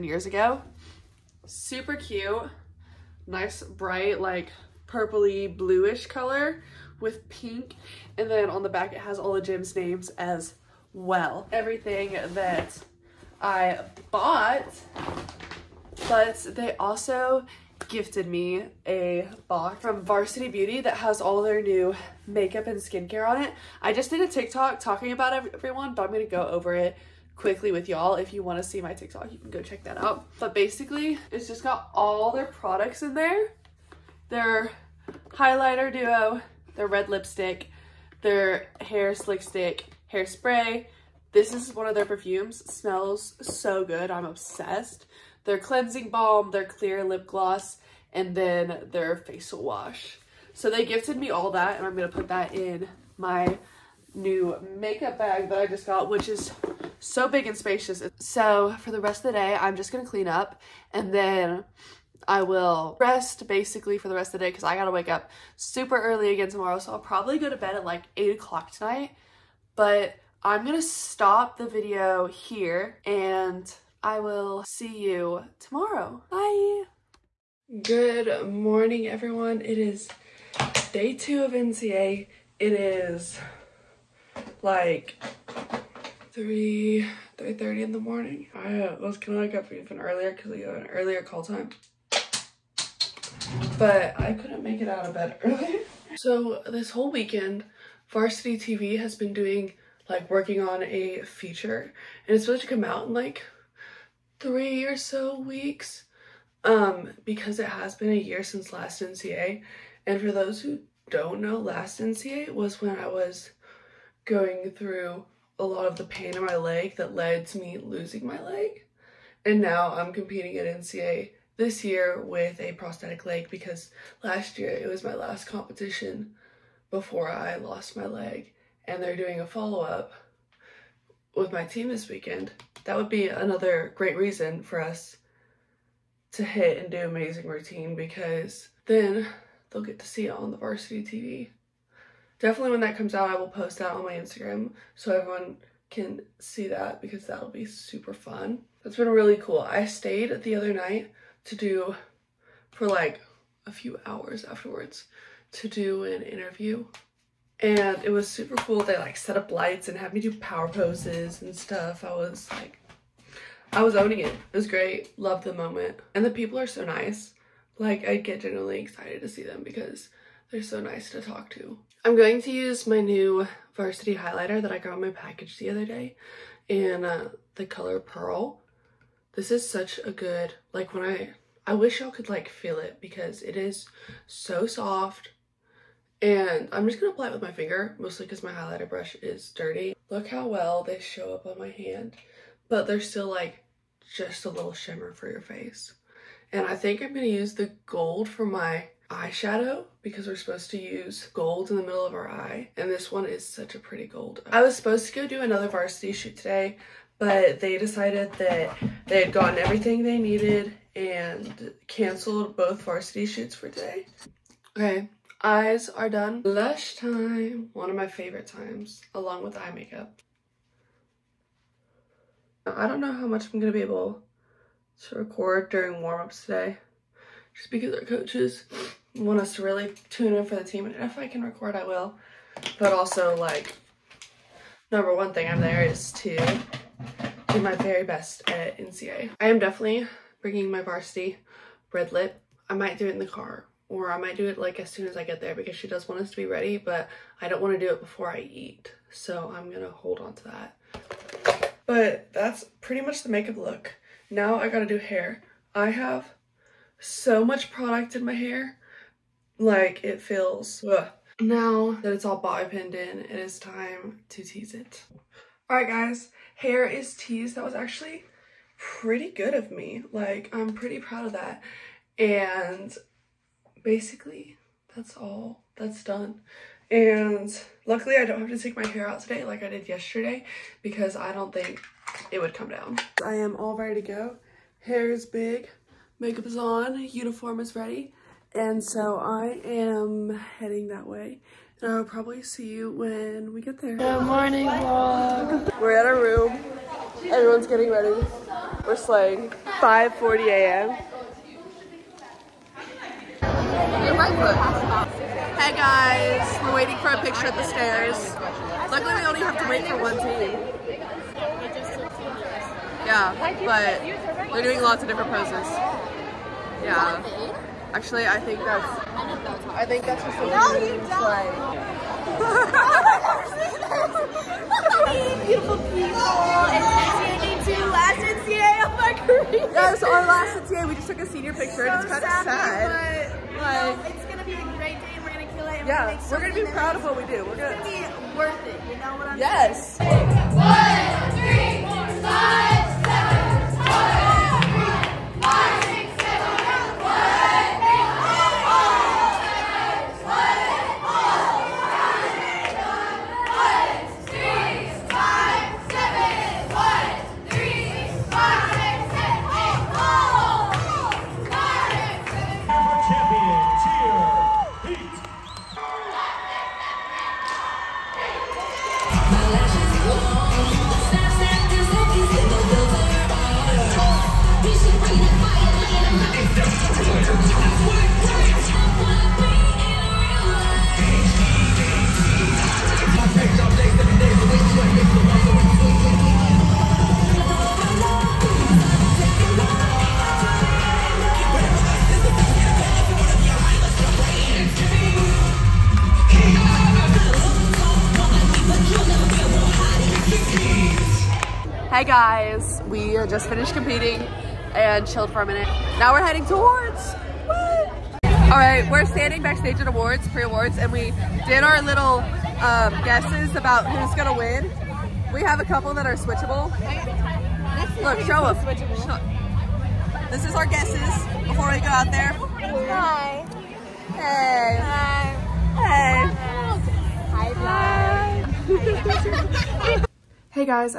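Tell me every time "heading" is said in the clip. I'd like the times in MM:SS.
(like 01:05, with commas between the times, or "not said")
04:50, 06:46.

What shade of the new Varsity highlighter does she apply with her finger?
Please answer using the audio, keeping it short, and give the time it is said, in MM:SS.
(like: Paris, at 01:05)
Pearl, at 02:57.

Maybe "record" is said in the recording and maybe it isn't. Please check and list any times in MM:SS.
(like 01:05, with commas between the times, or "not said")
03:45, 03:51.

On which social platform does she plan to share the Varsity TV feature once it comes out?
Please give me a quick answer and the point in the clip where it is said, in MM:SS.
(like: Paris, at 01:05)
Instagram, at 02:24.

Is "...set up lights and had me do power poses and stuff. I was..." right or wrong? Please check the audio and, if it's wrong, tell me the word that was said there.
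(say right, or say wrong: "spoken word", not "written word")
right.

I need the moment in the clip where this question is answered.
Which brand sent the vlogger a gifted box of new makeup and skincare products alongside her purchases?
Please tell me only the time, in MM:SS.
00:20.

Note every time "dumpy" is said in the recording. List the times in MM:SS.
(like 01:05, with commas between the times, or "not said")
not said.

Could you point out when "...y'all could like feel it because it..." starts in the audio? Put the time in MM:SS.
03:01.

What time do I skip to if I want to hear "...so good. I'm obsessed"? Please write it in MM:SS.
00:43.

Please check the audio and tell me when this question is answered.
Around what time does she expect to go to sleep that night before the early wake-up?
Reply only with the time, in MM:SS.
01:08.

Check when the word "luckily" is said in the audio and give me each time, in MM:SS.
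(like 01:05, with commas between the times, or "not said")
04:37, 05:08.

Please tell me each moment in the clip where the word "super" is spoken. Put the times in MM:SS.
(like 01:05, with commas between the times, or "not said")
00:01, 01:05, 02:27, 02:38.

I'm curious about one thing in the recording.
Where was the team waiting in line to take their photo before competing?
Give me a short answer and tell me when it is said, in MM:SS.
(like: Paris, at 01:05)
the stairs, at 05:07.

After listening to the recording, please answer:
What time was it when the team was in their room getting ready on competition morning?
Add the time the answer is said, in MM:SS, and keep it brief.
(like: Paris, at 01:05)
5:40 a.m., at 04:59.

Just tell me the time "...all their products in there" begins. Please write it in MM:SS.
00:31.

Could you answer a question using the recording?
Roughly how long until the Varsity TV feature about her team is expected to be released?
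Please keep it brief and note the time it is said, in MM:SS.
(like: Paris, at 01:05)
3 weeks, at 01:44.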